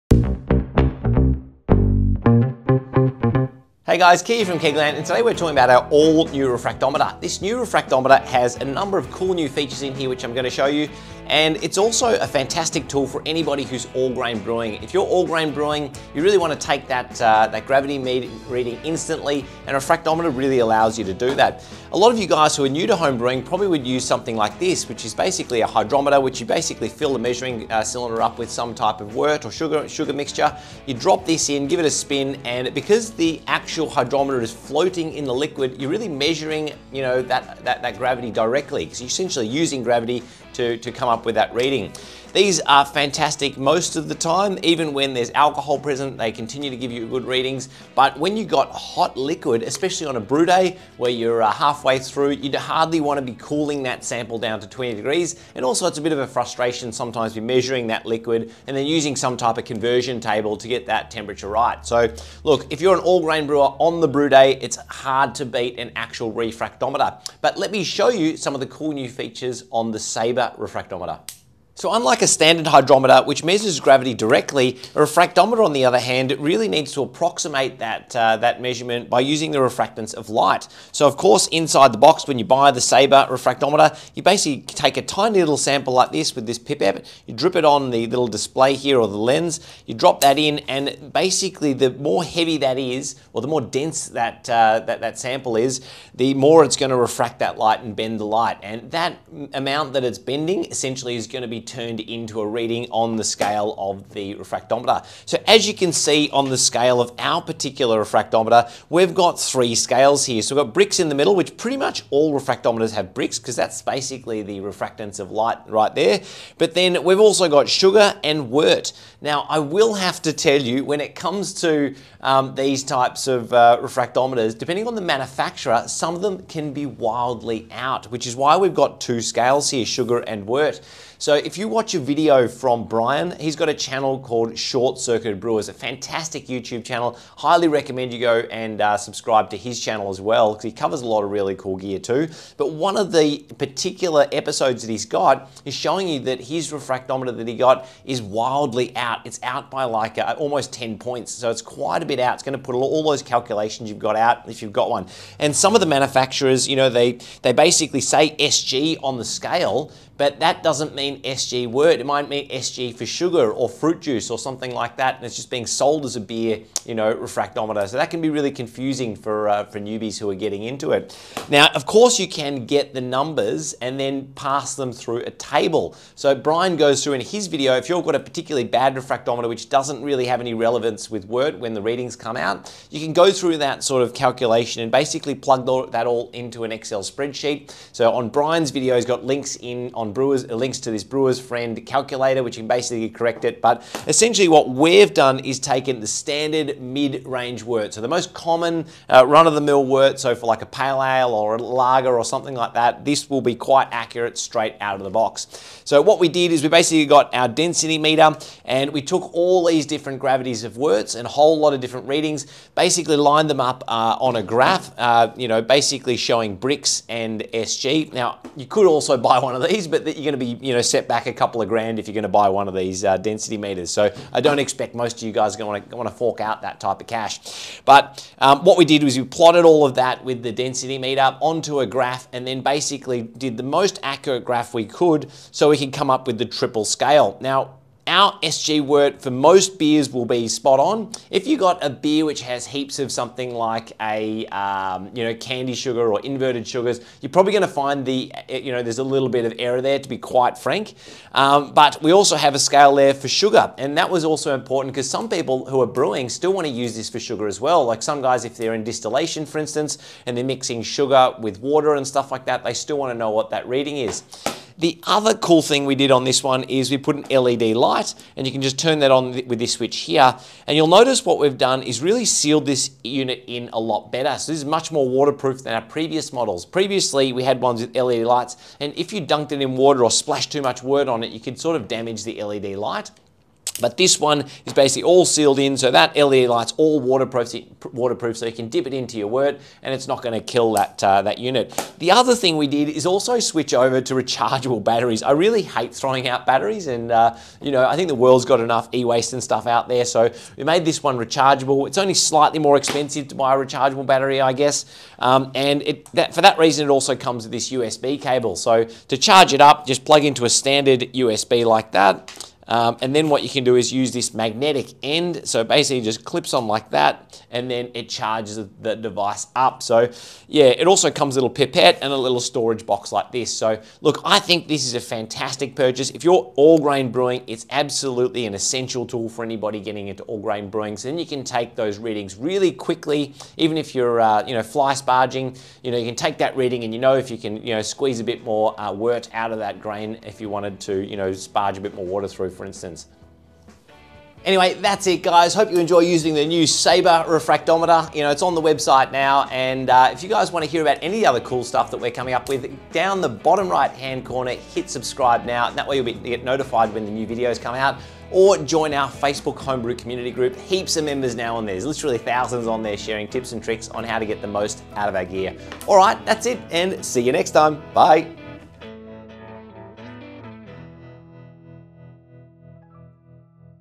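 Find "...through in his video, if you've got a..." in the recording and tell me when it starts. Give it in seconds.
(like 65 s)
177 s.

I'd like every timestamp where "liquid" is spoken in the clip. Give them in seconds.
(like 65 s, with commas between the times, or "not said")
35 s, 49 s, 58 s.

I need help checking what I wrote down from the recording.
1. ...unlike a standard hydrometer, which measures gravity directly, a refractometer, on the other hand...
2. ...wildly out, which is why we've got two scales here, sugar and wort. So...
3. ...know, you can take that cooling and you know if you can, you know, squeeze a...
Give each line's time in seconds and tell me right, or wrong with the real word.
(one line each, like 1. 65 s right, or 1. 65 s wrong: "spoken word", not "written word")
1. 71 s right
2. 126 s right
3. 335 s wrong: "reading", not "cooling".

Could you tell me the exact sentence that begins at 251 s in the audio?
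Um, but we also have a scale there for sugar.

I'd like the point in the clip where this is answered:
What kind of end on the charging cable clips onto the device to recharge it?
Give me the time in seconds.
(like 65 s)
314 s.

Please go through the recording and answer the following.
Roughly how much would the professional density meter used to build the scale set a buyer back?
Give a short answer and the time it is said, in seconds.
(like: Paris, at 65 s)
a couple of grand, at 221 s.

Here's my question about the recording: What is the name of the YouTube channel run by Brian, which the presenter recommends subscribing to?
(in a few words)
Short Circuit Brewers.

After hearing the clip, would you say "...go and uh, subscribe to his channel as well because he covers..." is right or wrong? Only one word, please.
right.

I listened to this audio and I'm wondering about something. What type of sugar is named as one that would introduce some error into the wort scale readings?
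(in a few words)
candi sugar.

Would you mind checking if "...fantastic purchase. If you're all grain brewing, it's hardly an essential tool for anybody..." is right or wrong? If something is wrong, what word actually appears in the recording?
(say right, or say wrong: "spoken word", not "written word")
wrong: "absolutely", not "hardly".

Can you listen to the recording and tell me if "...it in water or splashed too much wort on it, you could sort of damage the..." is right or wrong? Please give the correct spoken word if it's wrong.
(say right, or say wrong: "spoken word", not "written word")
right.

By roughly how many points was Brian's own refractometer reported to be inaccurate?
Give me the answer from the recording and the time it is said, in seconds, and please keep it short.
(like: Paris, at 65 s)
almost 10 points, at 150 s.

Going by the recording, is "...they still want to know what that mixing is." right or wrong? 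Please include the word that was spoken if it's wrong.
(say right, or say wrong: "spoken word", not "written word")
wrong: "reading", not "mixing".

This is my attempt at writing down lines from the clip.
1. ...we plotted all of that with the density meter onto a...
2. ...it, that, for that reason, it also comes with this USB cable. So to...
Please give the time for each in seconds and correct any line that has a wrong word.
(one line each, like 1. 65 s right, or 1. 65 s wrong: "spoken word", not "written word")
1. 229 s right
2. 305 s right.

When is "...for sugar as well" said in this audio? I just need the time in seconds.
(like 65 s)
257 s.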